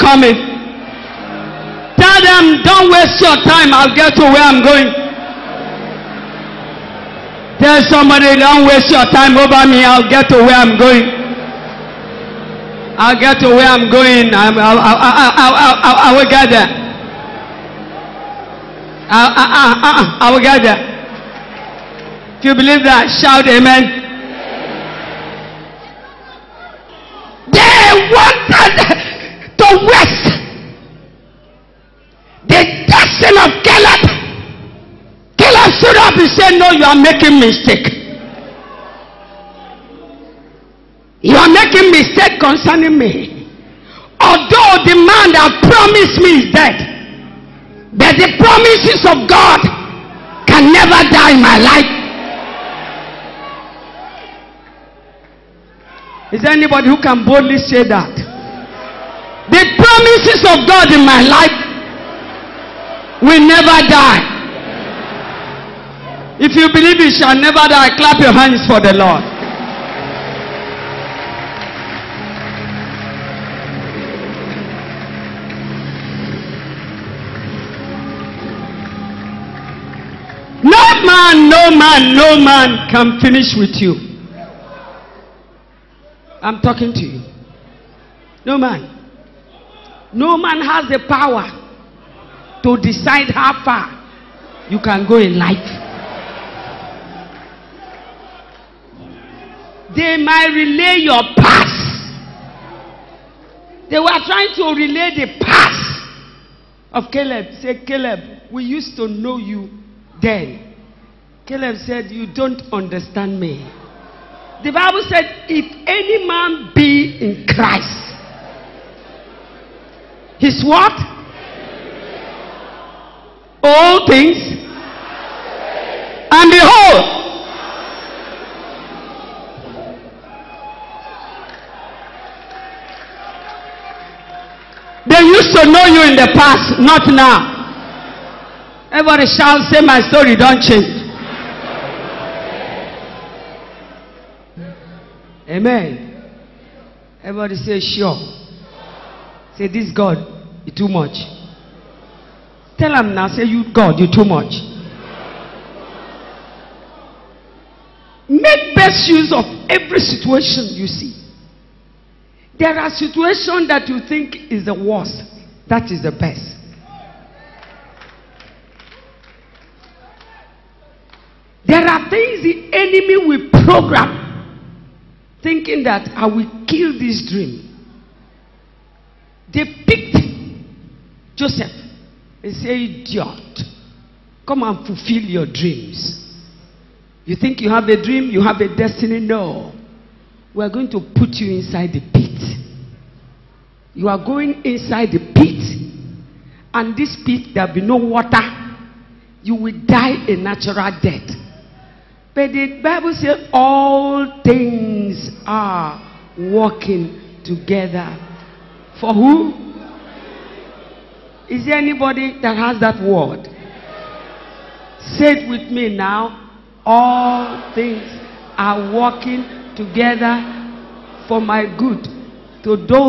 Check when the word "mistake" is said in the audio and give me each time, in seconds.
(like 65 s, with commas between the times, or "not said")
37 s, 41 s.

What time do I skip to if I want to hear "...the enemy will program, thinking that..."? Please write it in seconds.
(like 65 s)
172 s.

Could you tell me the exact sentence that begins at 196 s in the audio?
And this pit, there will be no water.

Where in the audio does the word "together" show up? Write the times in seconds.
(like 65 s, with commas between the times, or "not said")
207 s, 219 s.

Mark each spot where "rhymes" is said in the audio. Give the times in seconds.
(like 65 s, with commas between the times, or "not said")
not said.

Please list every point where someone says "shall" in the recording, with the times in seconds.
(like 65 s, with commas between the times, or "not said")
67 s, 139 s.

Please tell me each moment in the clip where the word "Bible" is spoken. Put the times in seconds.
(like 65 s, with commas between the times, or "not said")
114 s, 202 s.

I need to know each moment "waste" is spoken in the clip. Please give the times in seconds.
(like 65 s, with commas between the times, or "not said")
2 s, 8 s.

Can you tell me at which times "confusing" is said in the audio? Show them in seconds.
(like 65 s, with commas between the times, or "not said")
not said.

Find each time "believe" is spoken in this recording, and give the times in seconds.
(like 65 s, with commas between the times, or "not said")
22 s, 66 s.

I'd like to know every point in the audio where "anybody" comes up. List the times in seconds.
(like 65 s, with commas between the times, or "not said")
56 s, 211 s.